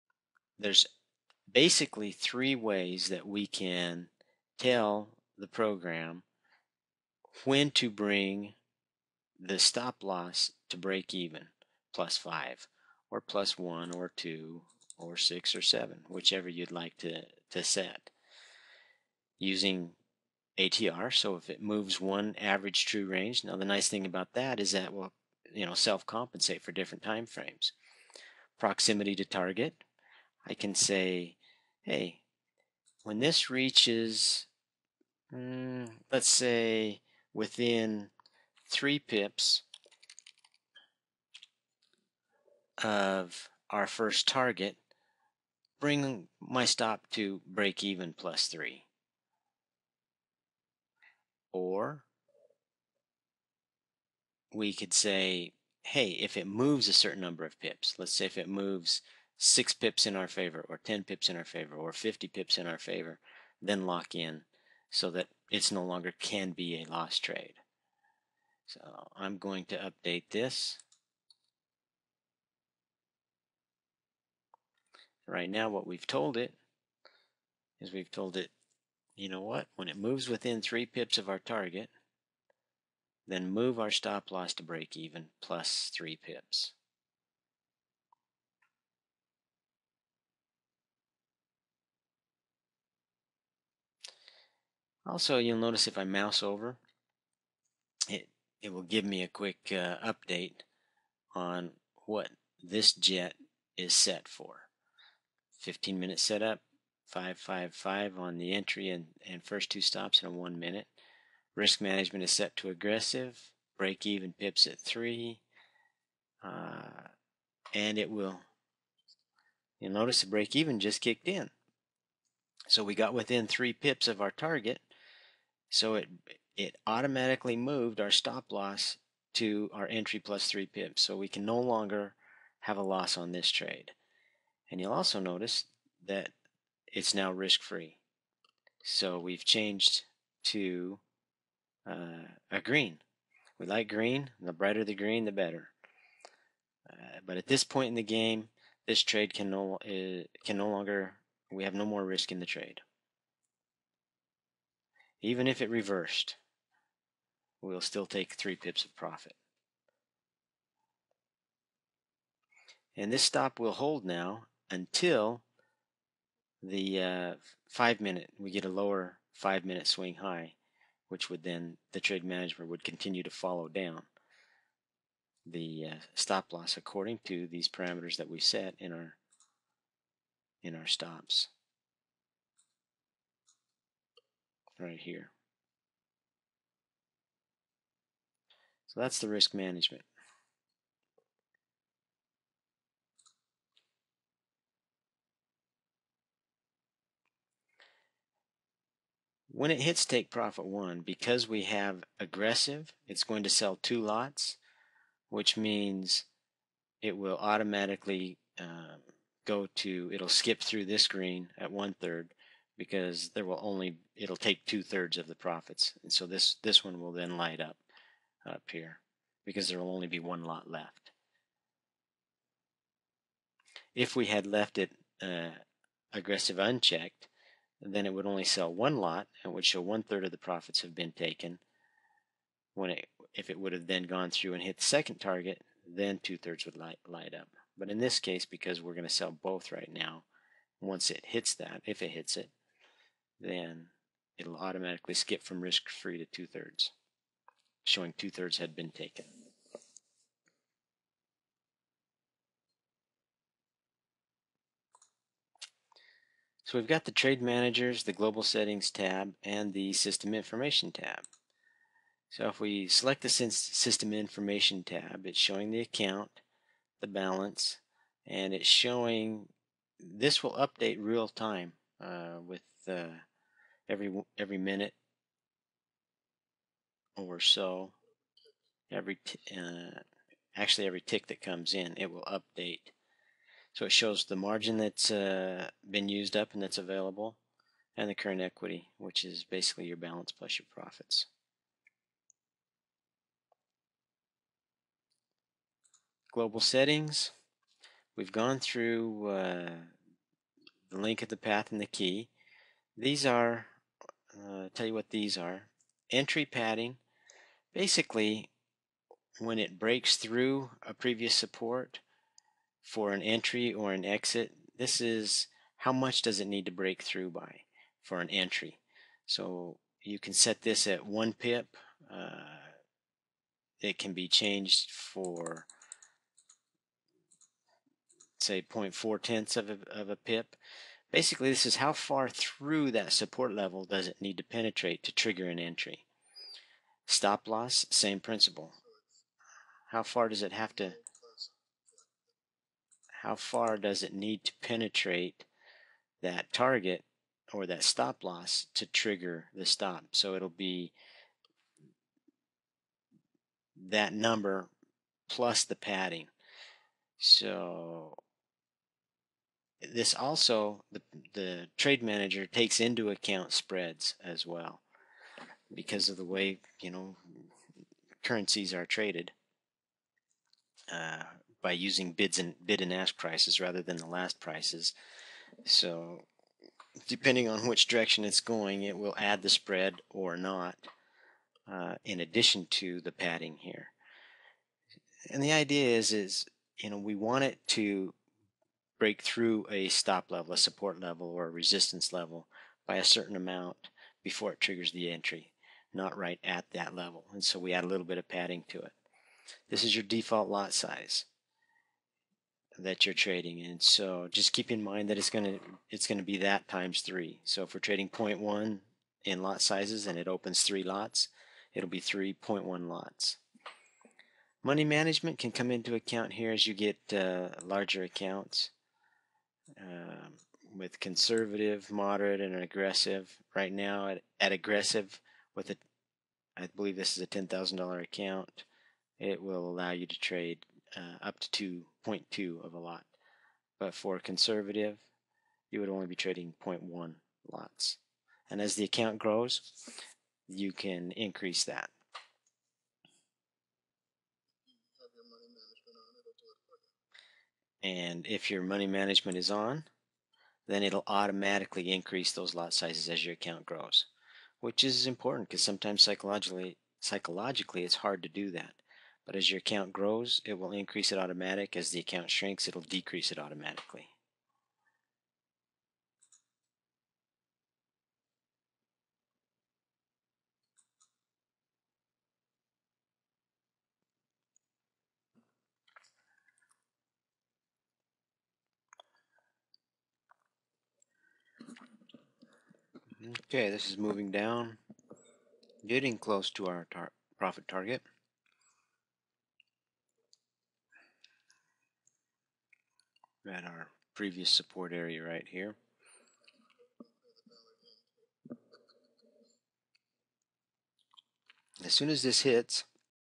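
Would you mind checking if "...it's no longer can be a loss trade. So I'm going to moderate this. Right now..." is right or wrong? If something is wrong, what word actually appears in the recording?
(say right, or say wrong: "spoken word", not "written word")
wrong: "update", not "moderate".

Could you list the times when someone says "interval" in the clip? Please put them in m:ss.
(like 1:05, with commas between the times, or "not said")
not said.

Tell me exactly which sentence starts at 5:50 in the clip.
So it'll be that number plus the padding.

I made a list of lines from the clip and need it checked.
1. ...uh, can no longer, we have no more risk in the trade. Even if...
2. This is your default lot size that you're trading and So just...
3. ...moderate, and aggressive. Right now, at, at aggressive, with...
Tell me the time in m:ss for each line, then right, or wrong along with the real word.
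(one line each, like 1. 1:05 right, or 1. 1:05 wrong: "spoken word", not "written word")
1. 2:29 right
2. 6:39 right
3. 7:01 right.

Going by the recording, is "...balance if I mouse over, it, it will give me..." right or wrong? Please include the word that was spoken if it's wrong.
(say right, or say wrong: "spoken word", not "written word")
wrong: "notice", not "balance".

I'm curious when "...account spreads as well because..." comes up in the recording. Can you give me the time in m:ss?
6:03.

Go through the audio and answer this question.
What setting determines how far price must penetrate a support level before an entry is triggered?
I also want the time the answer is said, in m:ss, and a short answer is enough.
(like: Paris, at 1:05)
Entry padding, at 5:06.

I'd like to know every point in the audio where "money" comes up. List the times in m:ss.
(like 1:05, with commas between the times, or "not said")
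6:54, 7:28.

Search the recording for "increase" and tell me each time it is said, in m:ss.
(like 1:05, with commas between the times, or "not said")
7:21, 7:31, 7:40.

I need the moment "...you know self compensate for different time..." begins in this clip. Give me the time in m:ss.
0:25.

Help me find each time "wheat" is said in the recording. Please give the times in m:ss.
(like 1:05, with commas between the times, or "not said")
not said.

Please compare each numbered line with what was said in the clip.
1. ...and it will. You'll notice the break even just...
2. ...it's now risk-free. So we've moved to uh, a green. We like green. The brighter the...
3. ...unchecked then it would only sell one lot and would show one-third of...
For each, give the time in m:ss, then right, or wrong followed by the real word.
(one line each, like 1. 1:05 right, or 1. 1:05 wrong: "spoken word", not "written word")
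1. 1:57 right
2. 2:16 wrong: "changed", not "moved"
3. 3:46 right.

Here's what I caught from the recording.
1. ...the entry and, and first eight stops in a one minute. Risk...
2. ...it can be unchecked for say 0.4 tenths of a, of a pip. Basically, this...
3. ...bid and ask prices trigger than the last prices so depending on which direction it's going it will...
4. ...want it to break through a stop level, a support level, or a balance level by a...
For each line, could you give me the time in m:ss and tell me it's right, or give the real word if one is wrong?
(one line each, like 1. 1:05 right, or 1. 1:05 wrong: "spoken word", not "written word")
1. 1:48 wrong: "two", not "eight"
2. 5:23 wrong: "changed", not "unchecked"
3. 6:12 wrong: "rather", not "trigger"
4. 6:27 wrong: "resistance", not "balance".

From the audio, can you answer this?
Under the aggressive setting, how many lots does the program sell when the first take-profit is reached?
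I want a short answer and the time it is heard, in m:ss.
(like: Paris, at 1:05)
2, at 3:23.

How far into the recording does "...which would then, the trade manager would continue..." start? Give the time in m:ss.
2:51.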